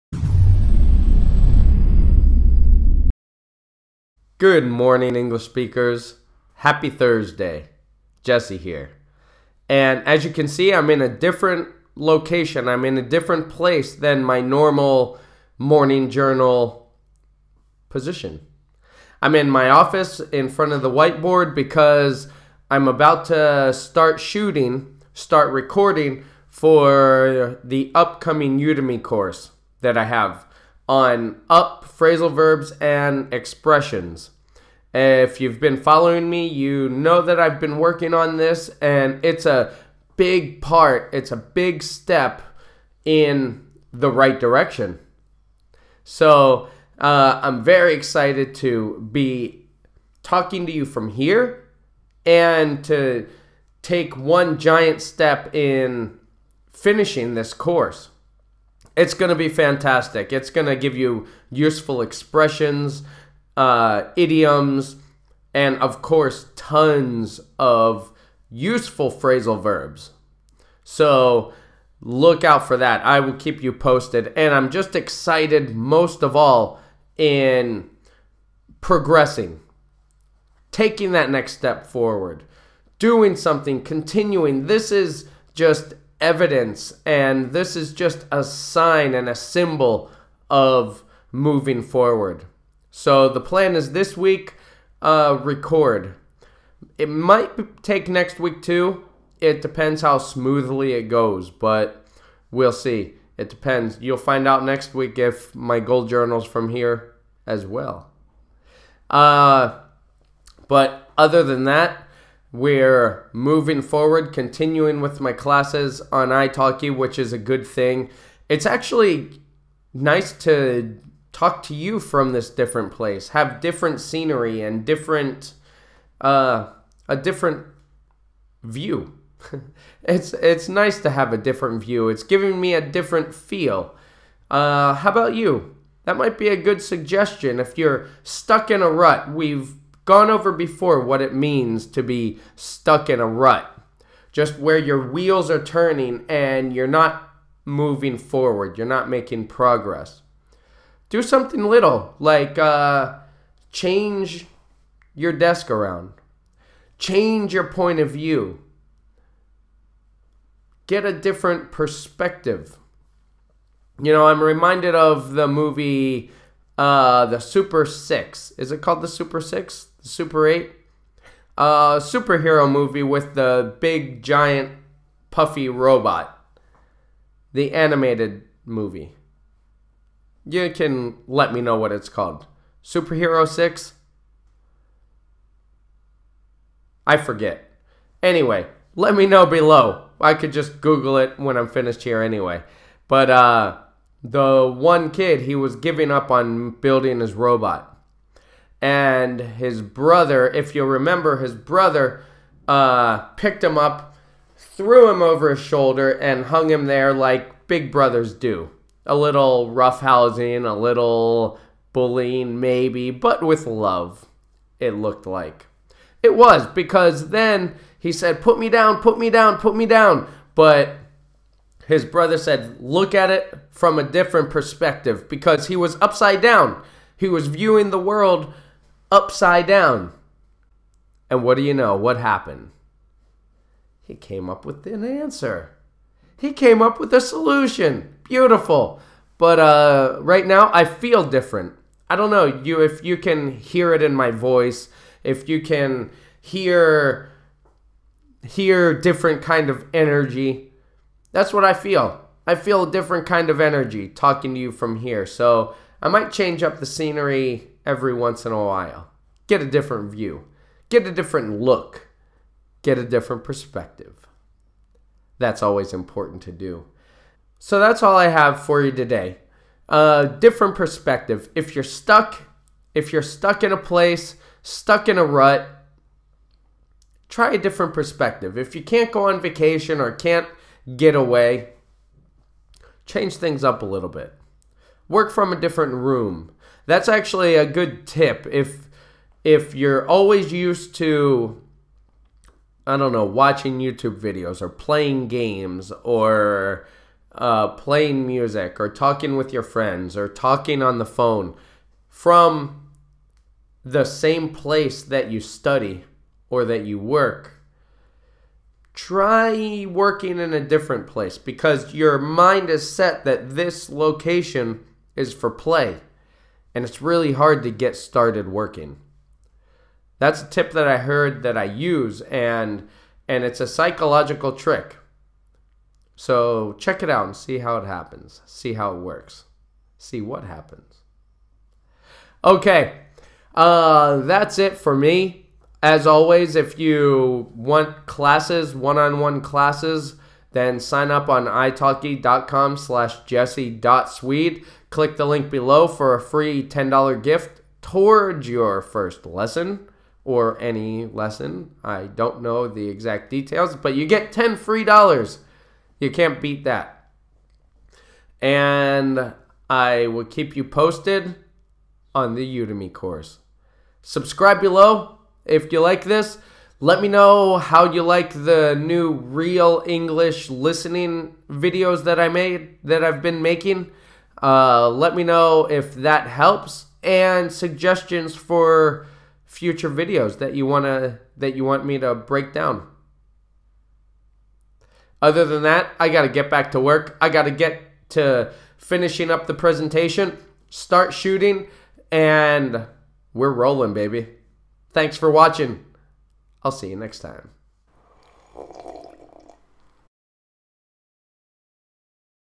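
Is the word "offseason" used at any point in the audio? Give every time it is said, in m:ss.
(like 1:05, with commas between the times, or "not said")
not said.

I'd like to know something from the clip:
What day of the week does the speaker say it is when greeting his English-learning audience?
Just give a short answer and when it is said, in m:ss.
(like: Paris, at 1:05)
Thursday, at 0:06.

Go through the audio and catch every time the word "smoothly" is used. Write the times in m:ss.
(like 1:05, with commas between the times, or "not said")
1:40.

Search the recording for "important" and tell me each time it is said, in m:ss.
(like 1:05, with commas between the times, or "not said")
4:25.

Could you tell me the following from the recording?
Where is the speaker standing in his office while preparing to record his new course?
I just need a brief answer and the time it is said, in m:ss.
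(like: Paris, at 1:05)
In front of the whiteboard, at 0:20.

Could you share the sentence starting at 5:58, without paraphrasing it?
And I will keep you posted on the Udemy course.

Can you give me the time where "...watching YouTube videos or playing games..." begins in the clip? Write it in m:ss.
4:53.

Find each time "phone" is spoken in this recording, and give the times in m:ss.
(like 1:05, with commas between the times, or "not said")
5:01.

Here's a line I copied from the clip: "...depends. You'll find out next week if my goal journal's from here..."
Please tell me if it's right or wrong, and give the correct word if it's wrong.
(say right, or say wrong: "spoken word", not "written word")
right.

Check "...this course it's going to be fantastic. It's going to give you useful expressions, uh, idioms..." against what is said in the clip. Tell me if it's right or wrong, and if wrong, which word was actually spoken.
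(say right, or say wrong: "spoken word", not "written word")
right.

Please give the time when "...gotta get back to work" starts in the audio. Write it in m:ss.
6:26.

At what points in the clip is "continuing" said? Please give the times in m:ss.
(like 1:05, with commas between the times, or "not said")
1:23, 1:54.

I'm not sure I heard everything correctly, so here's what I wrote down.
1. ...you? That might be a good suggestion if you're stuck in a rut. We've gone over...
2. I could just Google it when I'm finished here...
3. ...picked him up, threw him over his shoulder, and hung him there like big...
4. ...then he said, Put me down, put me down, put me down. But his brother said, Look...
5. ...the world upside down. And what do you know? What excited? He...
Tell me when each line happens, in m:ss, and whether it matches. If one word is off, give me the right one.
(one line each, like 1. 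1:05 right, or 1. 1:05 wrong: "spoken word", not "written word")
1. 2:15 right
2. 3:10 right
3. 3:23 right
4. 3:37 right
5. 3:47 wrong: "happened", not "excited".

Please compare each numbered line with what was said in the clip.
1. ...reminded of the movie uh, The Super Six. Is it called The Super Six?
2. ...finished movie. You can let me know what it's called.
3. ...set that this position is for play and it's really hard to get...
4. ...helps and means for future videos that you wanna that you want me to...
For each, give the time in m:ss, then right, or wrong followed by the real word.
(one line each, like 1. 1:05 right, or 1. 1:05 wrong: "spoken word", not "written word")
1. 2:44 right
2. 2:57 wrong: "animated", not "finished"
3. 5:12 wrong: "location", not "position"
4. 6:16 wrong: "suggestions", not "means".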